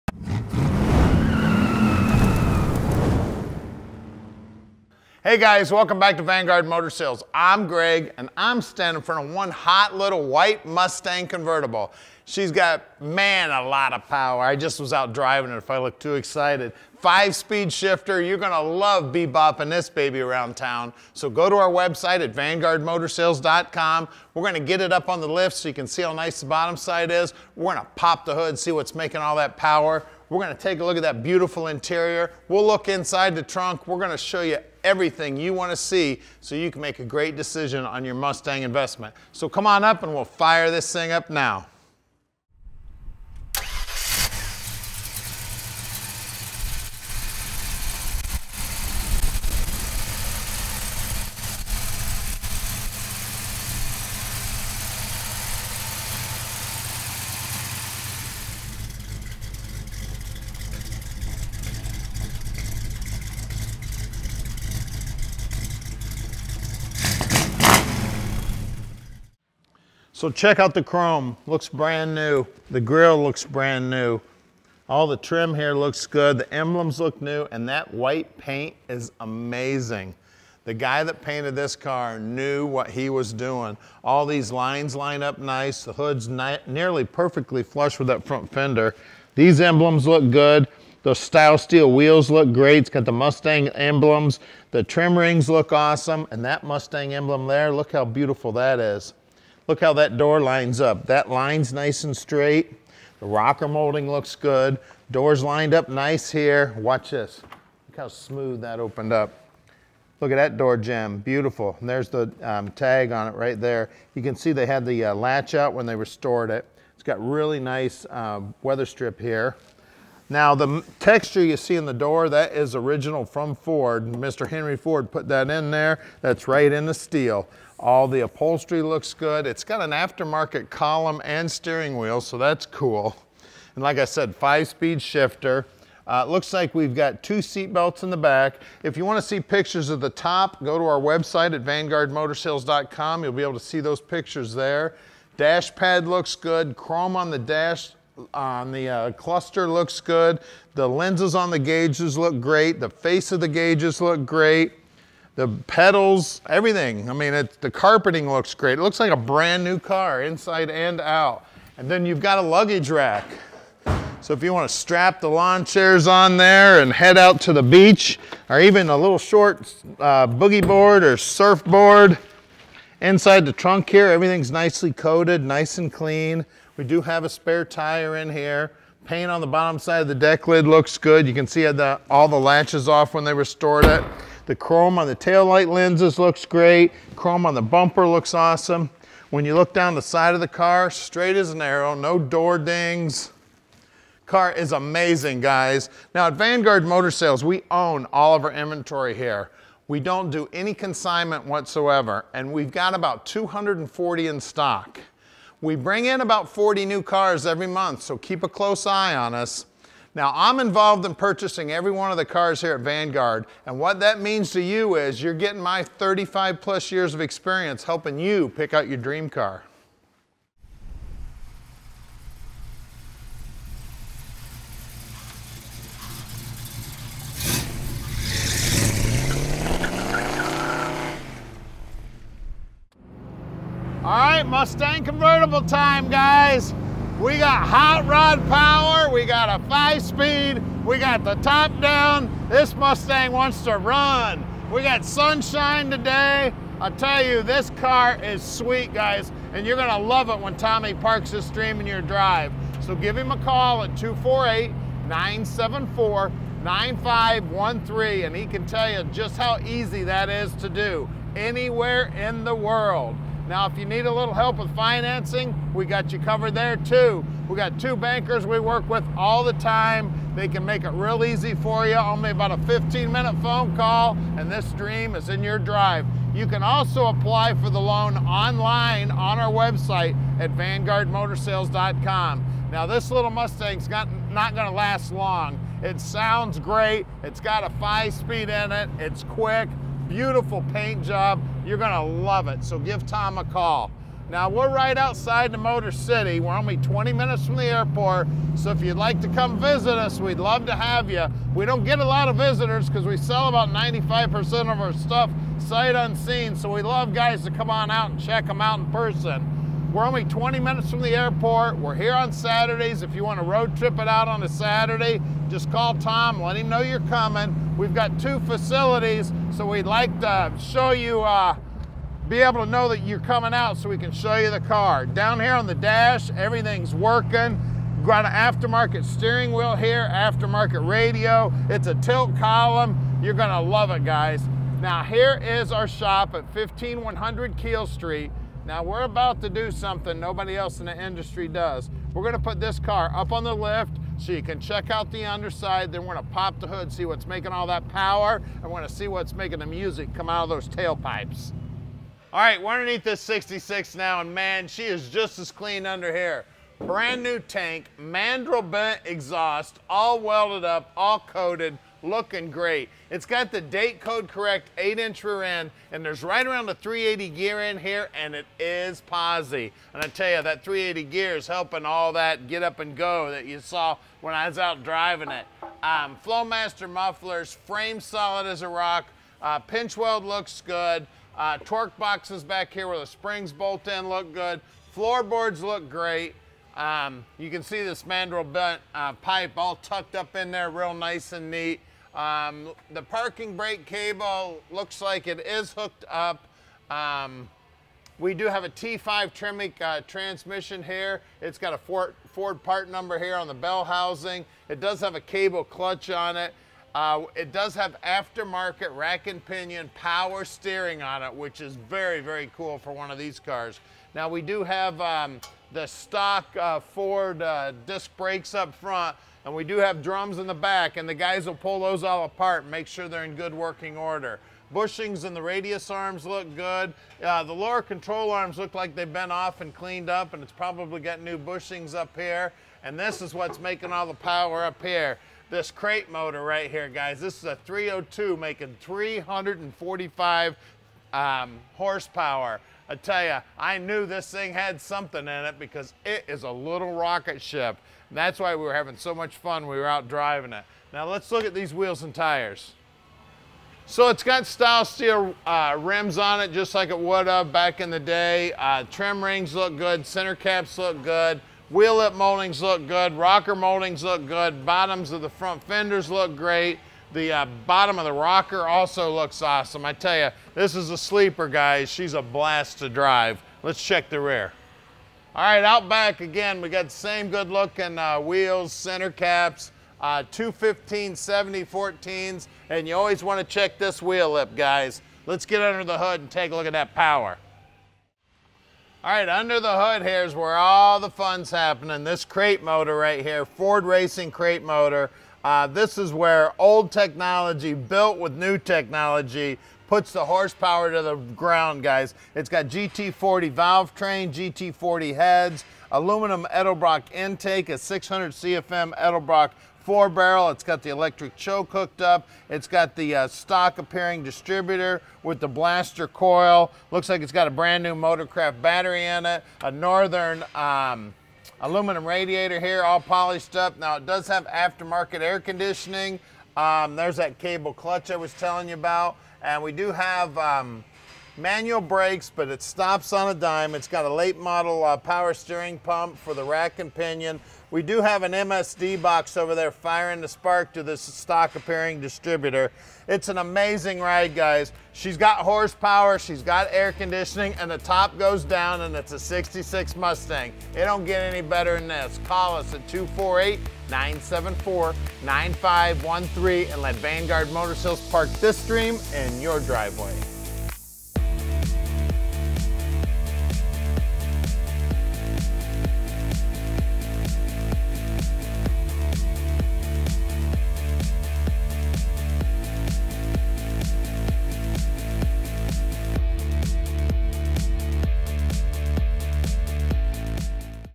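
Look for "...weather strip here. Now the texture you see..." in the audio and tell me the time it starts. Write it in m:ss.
1:58.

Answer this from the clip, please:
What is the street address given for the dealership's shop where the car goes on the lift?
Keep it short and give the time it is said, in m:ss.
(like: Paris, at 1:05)
15100 Keel Street, at 5:36.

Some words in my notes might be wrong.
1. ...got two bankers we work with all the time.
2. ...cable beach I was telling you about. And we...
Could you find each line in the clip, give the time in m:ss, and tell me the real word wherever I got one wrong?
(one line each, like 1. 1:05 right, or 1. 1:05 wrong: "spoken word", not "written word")
1. 4:27 right
2. 8:47 wrong: "clutch", not "beach".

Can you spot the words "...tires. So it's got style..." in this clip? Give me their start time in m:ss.
7:32.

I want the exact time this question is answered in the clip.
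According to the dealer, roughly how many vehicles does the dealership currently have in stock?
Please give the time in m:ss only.
3:22.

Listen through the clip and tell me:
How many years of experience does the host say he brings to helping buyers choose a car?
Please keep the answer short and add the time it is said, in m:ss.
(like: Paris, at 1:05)
35+, at 3:35.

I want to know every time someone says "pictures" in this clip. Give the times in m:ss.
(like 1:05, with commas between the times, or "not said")
2:19, 2:23.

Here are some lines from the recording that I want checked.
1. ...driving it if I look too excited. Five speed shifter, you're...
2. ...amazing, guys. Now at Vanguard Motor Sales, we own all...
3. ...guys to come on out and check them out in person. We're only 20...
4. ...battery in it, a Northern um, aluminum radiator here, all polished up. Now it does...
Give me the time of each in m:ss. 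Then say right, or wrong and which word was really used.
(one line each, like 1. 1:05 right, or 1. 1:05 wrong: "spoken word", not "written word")
1. 0:15 right
2. 3:14 right
3. 5:07 right
4. 8:38 right.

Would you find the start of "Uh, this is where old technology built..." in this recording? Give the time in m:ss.
8:15.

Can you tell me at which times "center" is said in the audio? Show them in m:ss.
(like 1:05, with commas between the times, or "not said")
7:40, 7:58.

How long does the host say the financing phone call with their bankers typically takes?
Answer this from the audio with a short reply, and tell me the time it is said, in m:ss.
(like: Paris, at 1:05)
15 minutes, at 4:32.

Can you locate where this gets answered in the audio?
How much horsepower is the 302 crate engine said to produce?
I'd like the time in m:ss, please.
7:18.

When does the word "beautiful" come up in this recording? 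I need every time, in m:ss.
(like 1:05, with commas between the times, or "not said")
0:31, 1:38, 1:51, 4:50.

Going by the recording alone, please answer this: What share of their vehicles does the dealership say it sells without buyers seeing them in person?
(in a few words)
95%.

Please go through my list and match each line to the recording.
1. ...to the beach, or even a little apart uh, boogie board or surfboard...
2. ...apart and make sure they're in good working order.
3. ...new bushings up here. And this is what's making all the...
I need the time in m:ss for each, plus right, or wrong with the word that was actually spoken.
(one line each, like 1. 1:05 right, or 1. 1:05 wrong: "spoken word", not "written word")
1. 2:47 wrong: "short", not "apart"
2. 7:02 right
3. 7:11 right.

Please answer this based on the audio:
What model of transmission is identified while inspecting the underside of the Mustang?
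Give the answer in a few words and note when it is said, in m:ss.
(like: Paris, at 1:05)
T5 Tremec, at 6:38.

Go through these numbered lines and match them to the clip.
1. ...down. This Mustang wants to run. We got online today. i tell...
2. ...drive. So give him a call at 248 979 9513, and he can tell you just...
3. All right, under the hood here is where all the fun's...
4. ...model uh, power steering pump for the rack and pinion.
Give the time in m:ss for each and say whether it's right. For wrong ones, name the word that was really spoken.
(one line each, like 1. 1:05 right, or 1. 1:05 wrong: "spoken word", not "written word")
1. 4:01 wrong: "sunshine", not "online"
2. 4:12 wrong: "974", not "979"
3. 8:09 right
4. 8:54 right.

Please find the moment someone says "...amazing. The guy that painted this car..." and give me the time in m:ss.
1:19.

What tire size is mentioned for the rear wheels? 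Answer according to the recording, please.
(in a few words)
215 70 14.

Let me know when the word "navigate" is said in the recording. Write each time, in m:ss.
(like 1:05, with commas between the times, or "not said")
not said.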